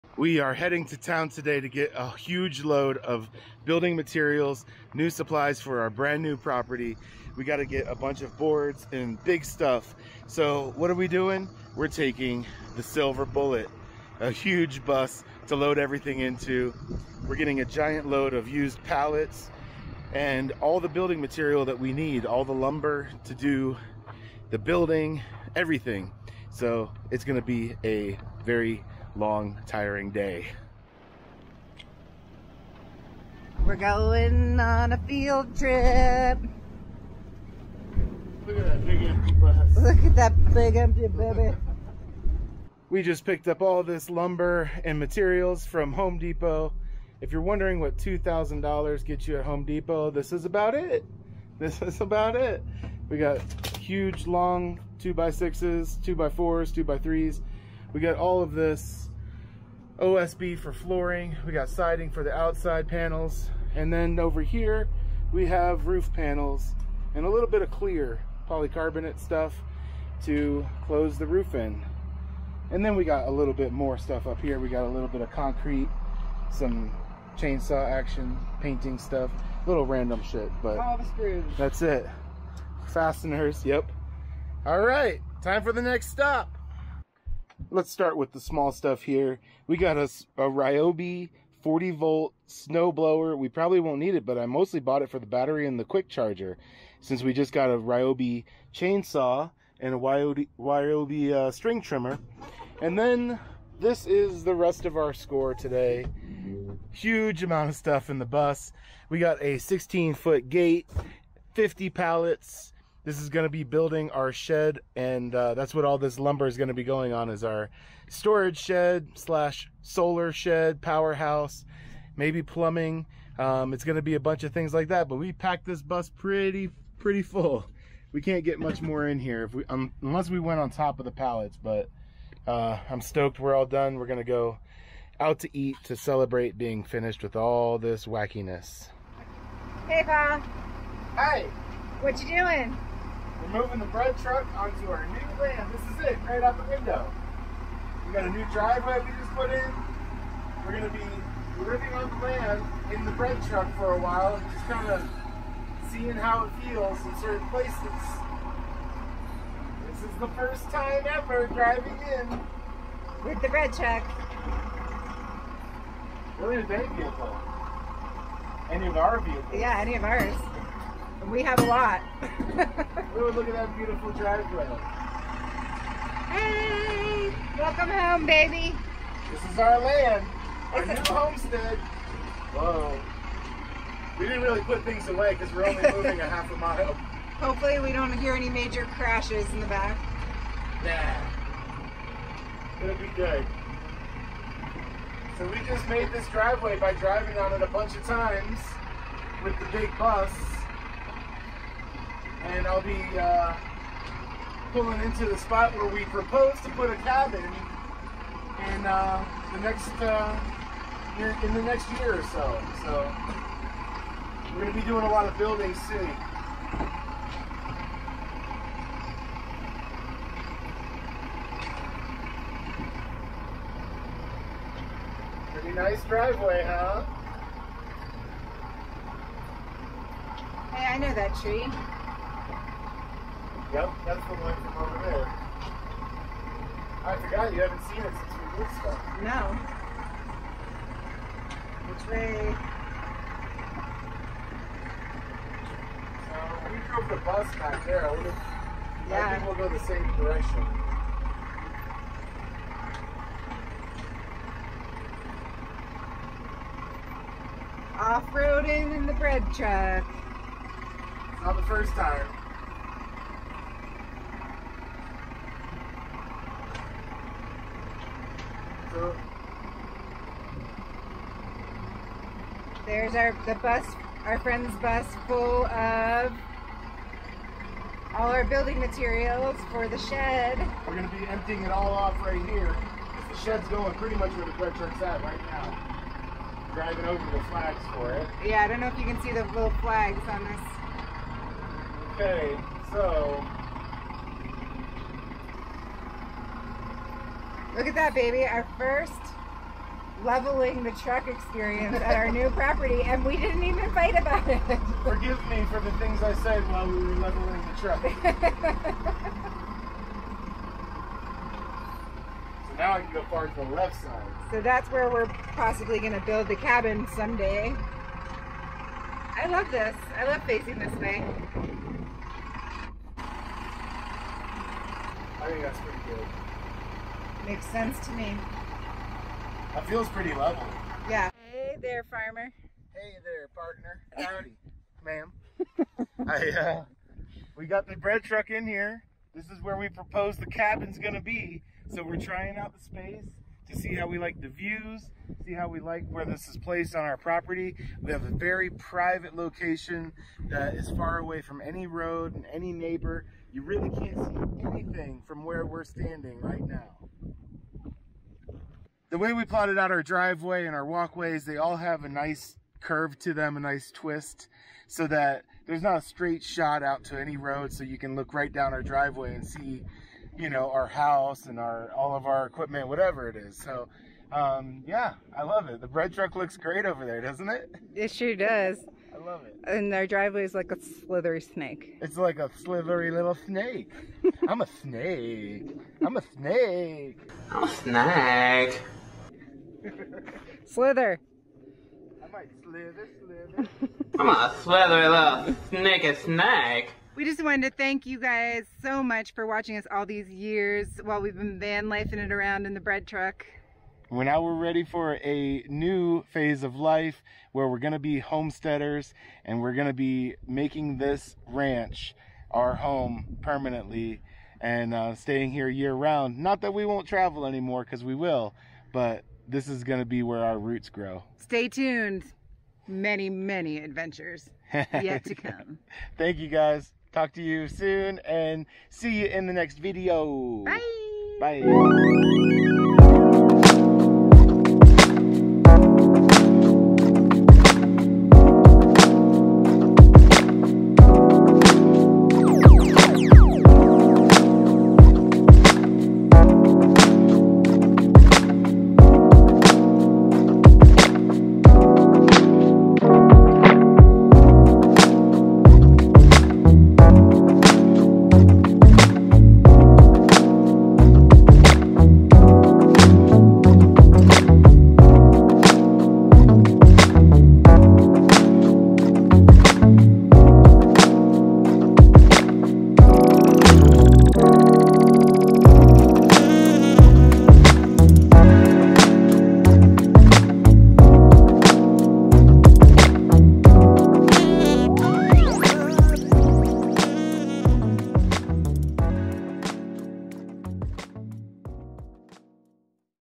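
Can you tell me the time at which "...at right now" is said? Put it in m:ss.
4:45.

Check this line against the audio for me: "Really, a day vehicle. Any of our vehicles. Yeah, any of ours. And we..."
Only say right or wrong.
right.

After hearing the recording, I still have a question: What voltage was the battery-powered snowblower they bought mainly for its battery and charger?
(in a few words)
40 volt.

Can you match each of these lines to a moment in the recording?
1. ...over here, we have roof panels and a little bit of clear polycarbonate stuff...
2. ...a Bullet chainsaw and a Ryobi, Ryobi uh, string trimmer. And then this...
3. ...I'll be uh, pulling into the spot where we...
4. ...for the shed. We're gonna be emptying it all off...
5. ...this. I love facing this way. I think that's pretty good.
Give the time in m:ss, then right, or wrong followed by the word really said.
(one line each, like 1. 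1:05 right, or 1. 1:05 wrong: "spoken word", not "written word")
1. 1:04 right
2. 1:37 wrong: "Ryobi", not "Bullet"
3. 3:22 right
4. 4:39 right
5. 5:19 right.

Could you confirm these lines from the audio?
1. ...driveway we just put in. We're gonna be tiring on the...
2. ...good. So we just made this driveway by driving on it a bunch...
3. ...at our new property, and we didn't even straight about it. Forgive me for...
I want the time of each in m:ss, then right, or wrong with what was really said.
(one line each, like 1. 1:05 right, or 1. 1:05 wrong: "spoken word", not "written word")
1. 2:28 wrong: "living", not "tiring"
2. 3:13 right
3. 5:01 wrong: "fight", not "straight".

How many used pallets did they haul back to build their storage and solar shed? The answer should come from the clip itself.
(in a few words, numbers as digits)
50.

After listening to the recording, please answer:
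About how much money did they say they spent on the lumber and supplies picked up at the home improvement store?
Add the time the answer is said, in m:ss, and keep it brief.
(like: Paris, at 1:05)
$2,000, at 0:47.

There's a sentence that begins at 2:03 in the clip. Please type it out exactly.
Um, it's going to be a bunch of things like that, but we packed this bus pretty, pretty full.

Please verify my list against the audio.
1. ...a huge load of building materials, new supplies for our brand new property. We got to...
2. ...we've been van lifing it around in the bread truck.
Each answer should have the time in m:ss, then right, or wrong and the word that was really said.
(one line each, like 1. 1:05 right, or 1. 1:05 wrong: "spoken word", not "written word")
1. 0:01 right
2. 6:41 right.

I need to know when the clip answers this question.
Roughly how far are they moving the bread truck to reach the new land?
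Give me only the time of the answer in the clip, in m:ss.
3:06.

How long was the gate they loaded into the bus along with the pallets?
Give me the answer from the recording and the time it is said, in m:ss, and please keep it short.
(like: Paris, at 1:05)
16 foot, at 1:49.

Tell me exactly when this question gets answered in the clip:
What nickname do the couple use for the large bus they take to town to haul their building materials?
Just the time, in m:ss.
0:12.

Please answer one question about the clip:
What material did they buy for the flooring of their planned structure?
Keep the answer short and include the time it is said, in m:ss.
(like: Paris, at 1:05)
OSB, at 0:59.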